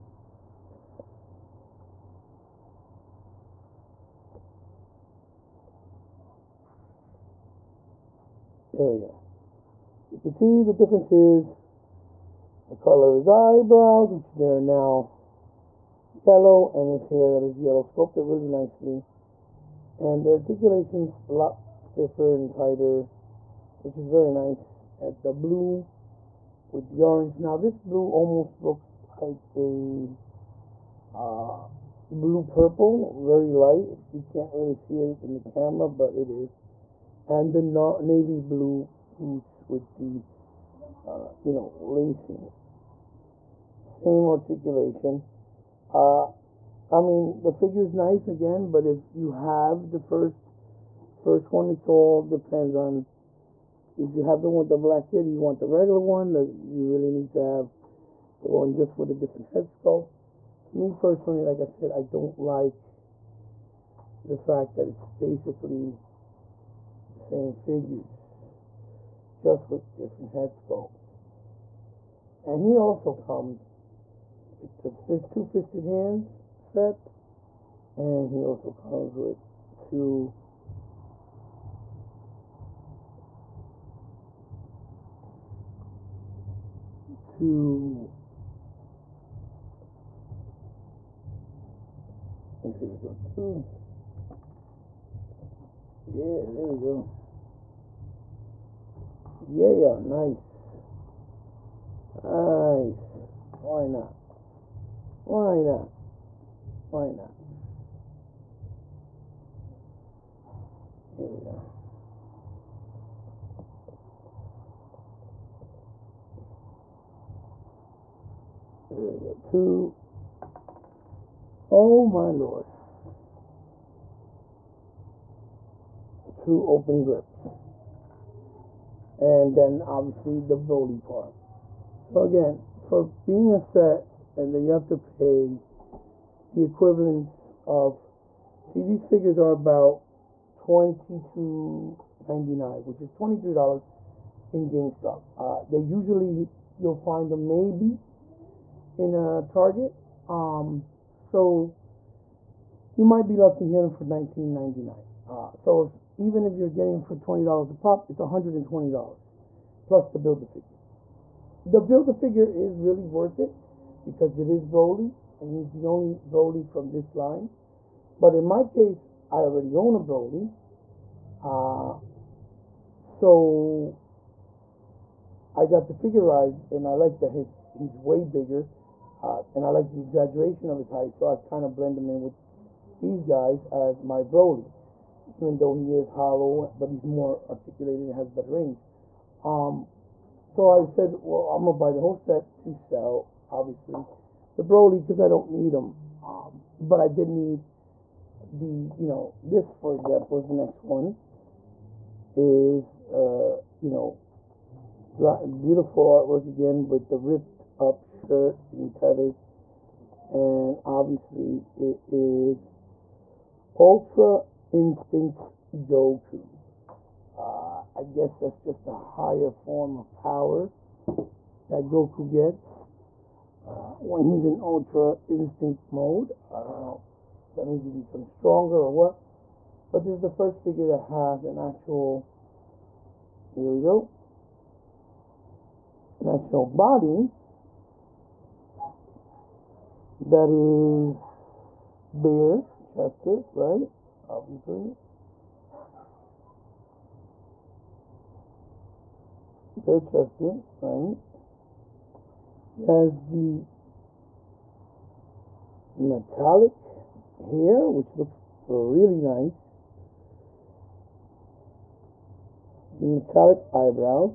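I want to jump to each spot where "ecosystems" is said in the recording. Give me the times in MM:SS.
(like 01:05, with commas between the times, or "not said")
not said.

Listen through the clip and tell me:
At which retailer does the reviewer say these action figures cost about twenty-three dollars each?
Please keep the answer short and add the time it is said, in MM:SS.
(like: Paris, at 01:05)
GameStop, at 02:24.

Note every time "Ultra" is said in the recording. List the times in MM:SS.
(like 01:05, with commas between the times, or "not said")
03:33, 03:44.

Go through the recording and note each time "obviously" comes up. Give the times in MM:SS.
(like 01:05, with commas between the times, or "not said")
02:09, 03:13, 03:30, 04:04.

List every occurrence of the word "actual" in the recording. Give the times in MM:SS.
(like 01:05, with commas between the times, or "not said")
03:51, 03:56.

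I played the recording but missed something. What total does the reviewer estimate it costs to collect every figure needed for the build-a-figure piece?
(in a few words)
$120.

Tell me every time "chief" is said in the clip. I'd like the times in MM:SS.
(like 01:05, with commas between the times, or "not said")
not said.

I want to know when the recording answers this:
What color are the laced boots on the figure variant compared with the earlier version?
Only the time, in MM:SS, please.
00:38.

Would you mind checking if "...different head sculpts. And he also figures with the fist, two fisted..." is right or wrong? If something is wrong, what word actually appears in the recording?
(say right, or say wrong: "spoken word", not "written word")
wrong: "comes", not "figures".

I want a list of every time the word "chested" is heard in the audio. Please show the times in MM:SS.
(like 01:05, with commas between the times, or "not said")
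04:02, 04:09.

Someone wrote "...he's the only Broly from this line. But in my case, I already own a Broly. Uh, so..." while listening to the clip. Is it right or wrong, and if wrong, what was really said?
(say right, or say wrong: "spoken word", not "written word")
right.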